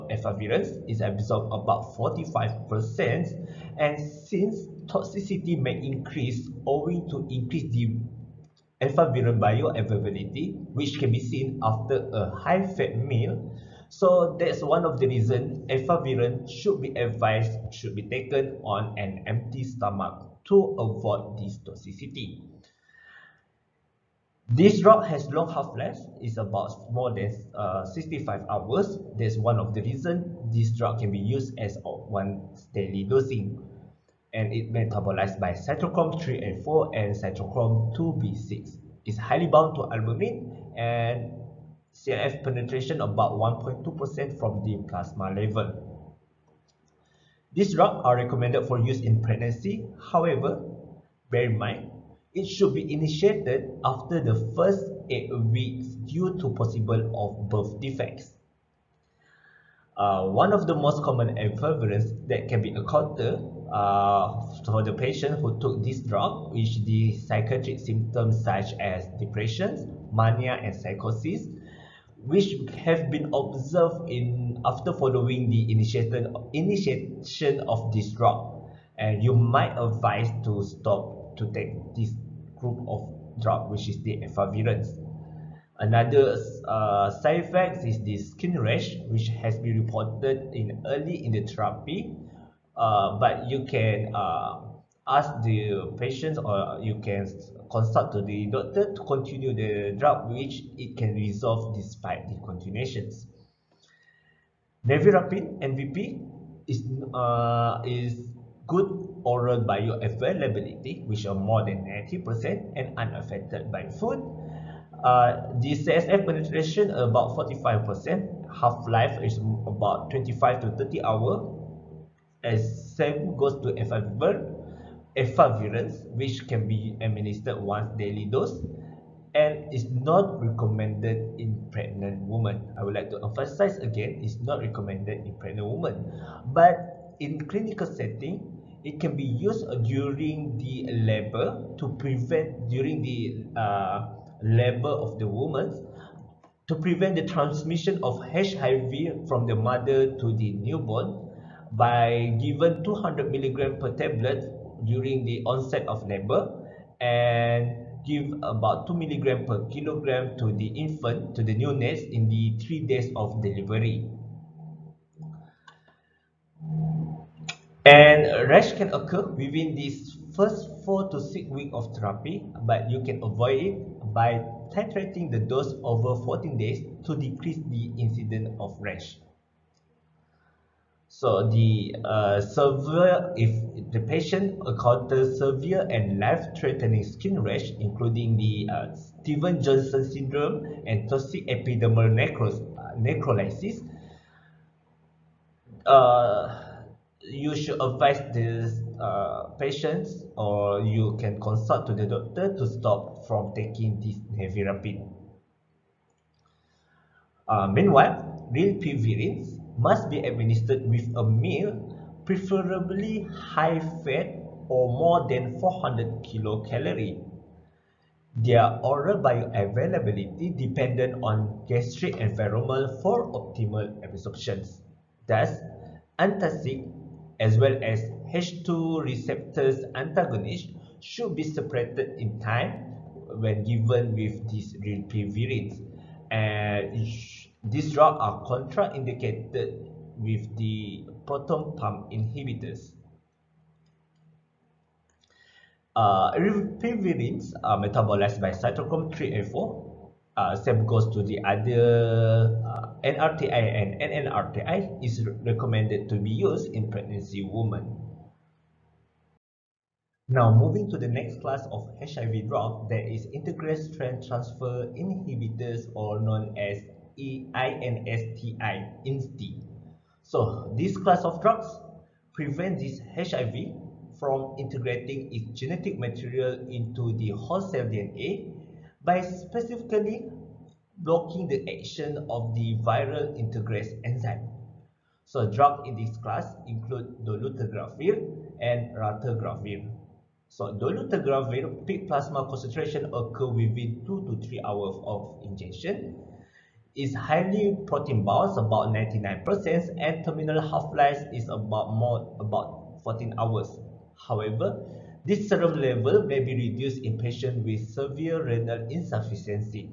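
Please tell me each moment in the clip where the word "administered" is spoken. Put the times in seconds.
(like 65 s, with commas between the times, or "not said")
127 s, 210 s.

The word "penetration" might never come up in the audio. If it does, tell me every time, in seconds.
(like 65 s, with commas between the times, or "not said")
42 s, 116 s.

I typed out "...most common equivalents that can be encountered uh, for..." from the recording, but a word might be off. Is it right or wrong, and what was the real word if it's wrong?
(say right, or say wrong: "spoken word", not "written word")
right.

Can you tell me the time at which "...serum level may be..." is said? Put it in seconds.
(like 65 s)
305 s.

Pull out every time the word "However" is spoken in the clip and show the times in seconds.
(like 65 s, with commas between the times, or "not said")
50 s, 304 s.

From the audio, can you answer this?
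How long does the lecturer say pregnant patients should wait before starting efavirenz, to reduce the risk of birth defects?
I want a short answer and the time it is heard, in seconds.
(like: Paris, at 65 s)
8 weeks, at 55 s.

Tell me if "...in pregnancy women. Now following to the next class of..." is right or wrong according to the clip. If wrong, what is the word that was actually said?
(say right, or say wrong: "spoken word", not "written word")
wrong: "moving", not "following".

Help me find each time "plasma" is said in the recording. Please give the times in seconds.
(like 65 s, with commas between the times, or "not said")
44 s, 292 s.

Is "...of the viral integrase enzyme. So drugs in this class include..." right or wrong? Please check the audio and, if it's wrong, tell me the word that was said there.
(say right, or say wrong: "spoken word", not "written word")
right.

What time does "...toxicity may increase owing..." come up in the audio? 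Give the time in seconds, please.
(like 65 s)
4 s.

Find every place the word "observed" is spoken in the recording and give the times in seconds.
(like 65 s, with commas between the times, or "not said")
73 s.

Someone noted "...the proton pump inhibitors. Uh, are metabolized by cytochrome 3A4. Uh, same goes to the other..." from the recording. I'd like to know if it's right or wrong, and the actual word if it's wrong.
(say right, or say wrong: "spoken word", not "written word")
right.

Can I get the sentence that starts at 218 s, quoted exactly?
Their oral bioavailability dependent on gastric environment for optimal absorptions.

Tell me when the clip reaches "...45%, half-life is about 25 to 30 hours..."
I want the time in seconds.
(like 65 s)
117 s.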